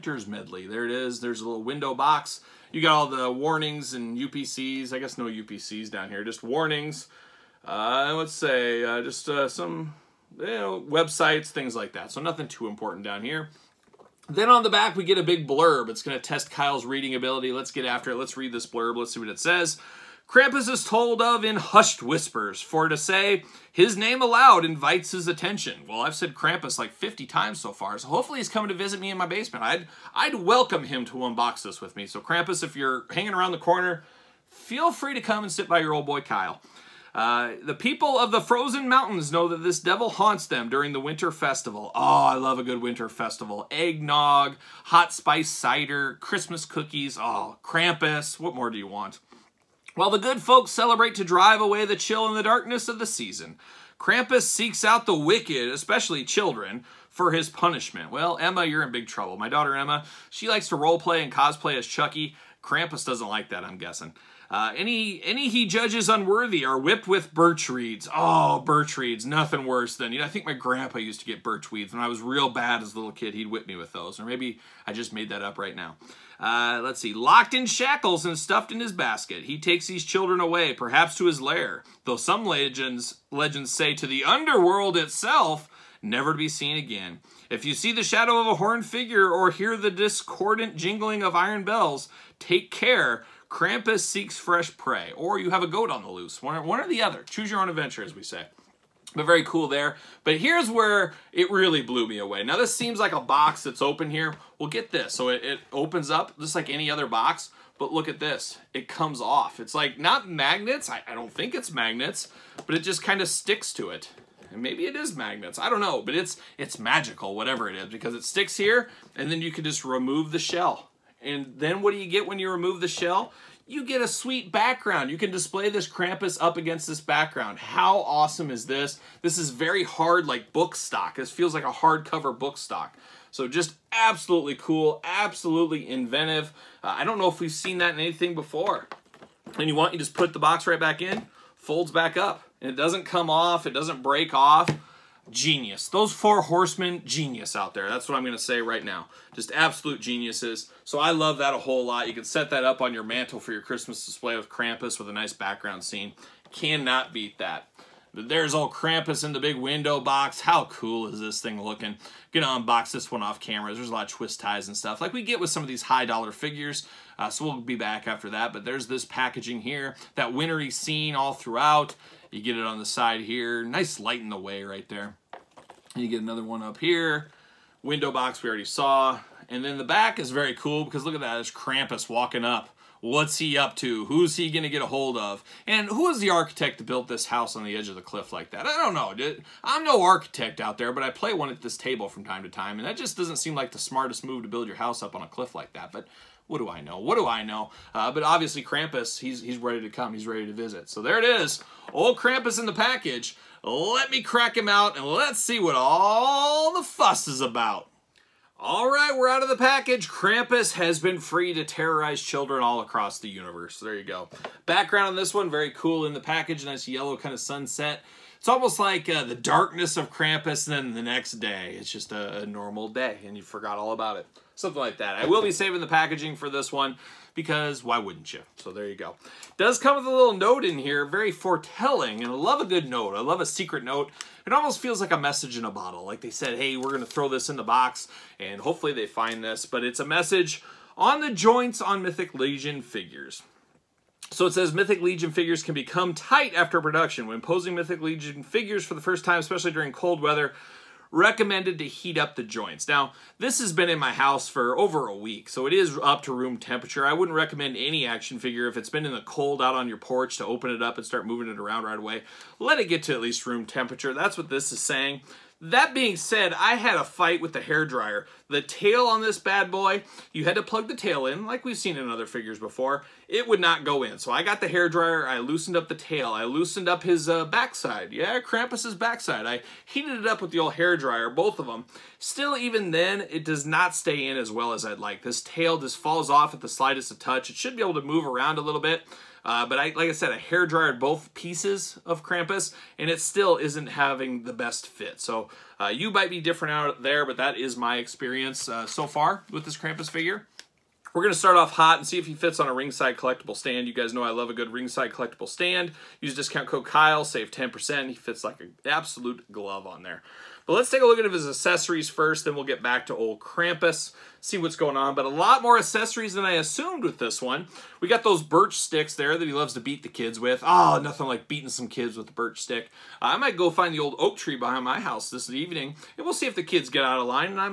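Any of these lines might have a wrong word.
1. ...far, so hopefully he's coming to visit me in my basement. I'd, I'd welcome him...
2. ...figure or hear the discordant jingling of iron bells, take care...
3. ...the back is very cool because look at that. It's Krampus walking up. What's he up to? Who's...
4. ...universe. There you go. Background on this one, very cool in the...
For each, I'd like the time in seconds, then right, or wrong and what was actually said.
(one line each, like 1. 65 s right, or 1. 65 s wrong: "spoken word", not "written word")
1. 27 s right
2. 88 s right
3. 179 s right
4. 213 s right.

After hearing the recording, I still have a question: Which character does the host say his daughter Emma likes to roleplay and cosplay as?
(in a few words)
Chucky.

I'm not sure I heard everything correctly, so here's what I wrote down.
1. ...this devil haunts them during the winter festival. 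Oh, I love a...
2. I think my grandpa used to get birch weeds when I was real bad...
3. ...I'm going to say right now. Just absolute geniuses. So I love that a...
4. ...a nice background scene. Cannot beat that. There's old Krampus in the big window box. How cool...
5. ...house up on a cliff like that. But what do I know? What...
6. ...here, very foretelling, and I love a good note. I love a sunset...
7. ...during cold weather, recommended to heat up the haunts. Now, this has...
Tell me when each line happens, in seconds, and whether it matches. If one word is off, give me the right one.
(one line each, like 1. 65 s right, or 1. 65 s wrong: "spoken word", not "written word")
1. 39 s right
2. 70 s right
3. 148 s right
4. 155 s right
5. 194 s right
6. 230 s wrong: "secret", not "sunset"
7. 249 s wrong: "joints", not "haunts".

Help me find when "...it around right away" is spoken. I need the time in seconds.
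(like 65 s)
261 s.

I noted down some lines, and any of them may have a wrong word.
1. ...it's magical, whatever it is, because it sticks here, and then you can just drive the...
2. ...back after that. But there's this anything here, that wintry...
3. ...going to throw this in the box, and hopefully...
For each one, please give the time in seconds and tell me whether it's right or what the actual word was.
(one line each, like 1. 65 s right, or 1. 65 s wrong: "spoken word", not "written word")
1. 116 s wrong: "remove", not "drive"
2. 167 s wrong: "packaging", not "anything"
3. 236 s right.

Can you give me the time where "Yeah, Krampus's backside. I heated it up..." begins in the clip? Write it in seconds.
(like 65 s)
278 s.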